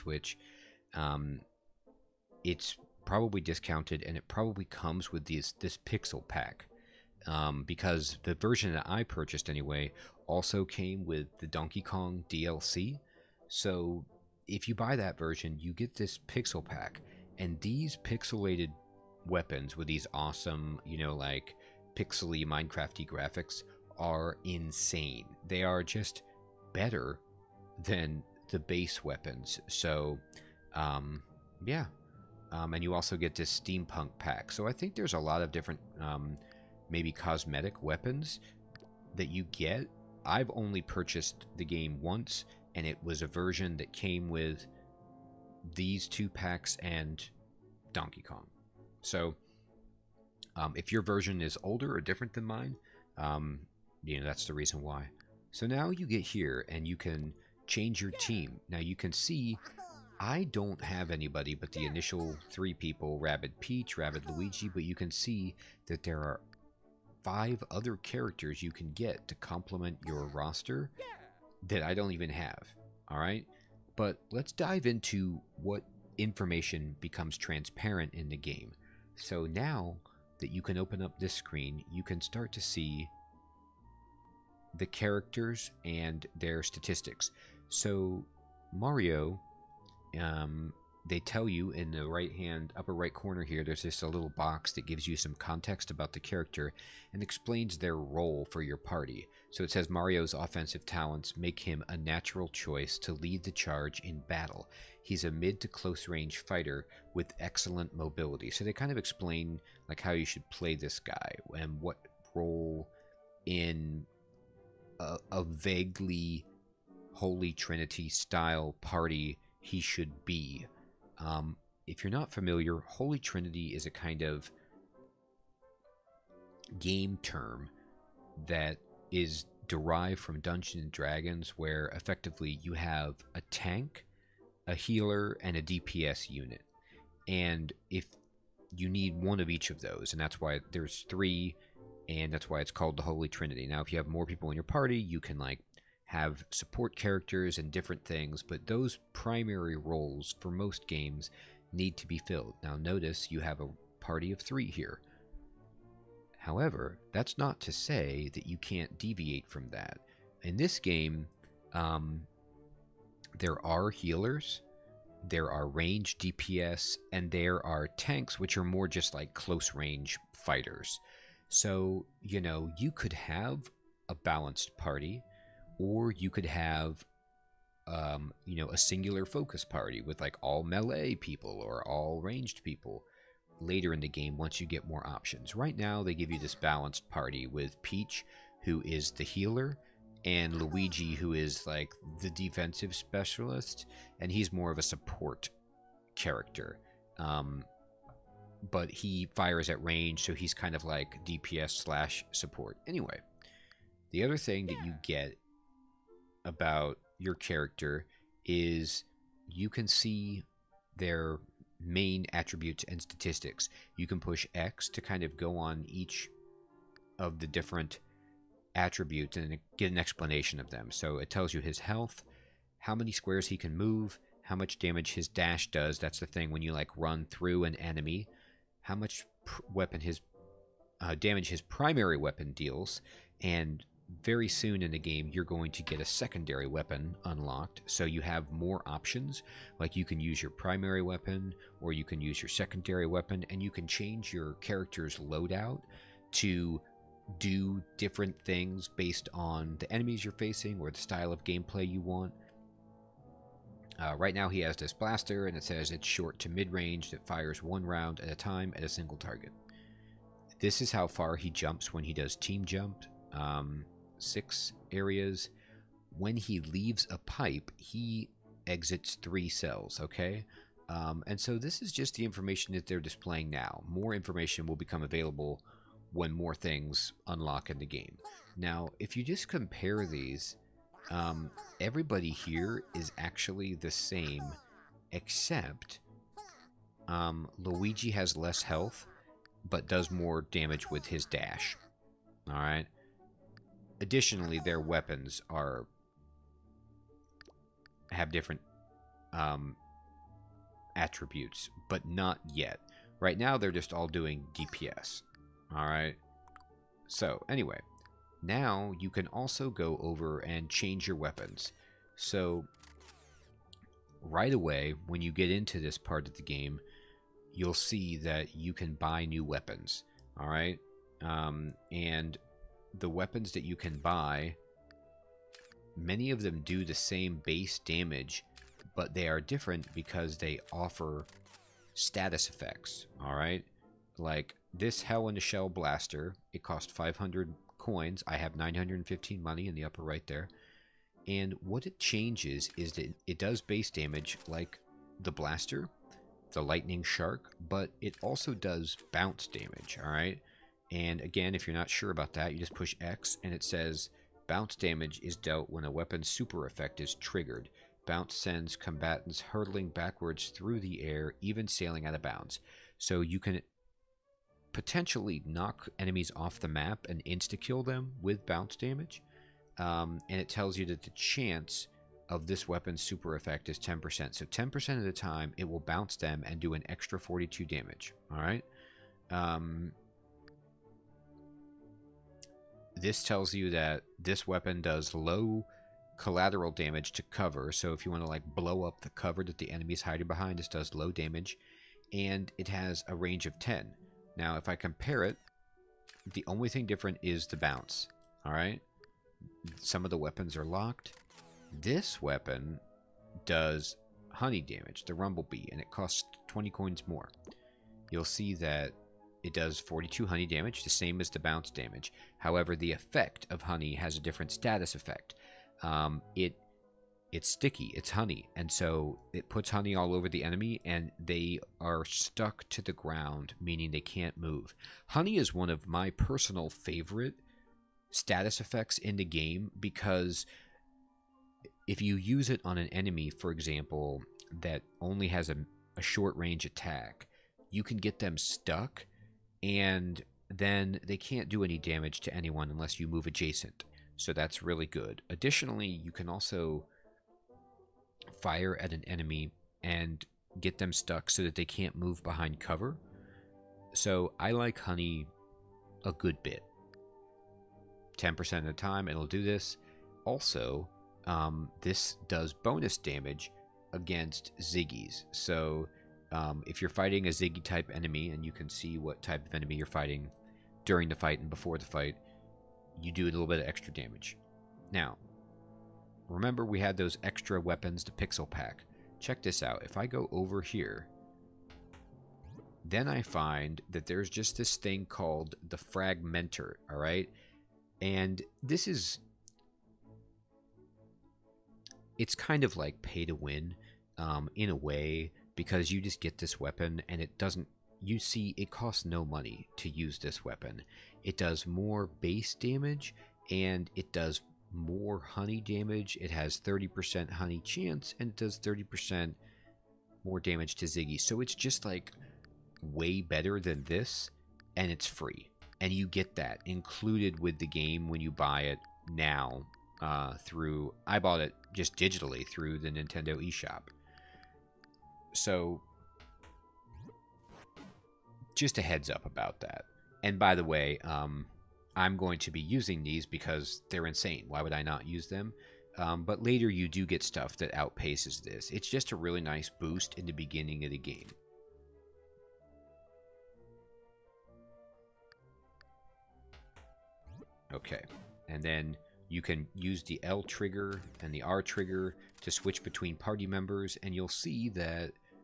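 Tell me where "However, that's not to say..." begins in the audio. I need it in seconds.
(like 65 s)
156 s.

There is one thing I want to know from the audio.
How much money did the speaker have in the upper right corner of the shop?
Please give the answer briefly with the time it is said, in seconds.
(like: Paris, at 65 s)
915, at 338 s.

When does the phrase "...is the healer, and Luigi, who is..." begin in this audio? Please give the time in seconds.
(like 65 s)
188 s.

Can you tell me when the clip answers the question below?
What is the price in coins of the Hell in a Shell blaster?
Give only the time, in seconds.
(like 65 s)
336 s.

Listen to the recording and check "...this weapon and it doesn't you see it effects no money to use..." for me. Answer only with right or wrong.
wrong.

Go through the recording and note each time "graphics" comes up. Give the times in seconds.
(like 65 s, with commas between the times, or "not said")
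23 s.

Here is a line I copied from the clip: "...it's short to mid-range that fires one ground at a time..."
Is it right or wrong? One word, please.
wrong.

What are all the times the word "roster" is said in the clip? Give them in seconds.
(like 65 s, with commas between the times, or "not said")
70 s.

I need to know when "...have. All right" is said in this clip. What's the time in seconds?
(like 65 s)
72 s.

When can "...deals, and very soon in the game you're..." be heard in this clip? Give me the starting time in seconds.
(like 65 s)
232 s.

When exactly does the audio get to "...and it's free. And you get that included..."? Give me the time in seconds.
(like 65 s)
514 s.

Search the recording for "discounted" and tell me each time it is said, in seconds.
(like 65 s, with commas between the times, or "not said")
3 s.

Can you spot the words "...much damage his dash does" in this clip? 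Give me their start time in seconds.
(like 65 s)
224 s.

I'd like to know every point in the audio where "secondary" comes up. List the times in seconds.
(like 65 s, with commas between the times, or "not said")
236 s, 242 s.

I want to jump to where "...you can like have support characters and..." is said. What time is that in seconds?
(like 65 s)
144 s.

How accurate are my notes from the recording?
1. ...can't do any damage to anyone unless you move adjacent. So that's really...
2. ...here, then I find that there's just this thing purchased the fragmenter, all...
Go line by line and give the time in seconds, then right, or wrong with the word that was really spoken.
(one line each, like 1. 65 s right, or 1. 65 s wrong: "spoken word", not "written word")
1. 441 s right
2. 480 s wrong: "called", not "purchased".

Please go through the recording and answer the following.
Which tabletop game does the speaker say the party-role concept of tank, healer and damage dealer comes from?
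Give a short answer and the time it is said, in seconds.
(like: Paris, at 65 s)
Dungeons and Dragons, at 130 s.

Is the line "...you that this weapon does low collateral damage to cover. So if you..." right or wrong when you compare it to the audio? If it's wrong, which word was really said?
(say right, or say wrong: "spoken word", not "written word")
right.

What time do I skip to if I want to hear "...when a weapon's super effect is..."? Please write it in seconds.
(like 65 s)
355 s.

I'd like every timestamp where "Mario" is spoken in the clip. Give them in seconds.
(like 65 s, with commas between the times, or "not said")
88 s, 99 s.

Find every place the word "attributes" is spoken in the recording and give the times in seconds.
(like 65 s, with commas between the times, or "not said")
212 s, 218 s, 300 s.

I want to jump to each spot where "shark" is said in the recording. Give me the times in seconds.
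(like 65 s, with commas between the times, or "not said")
347 s.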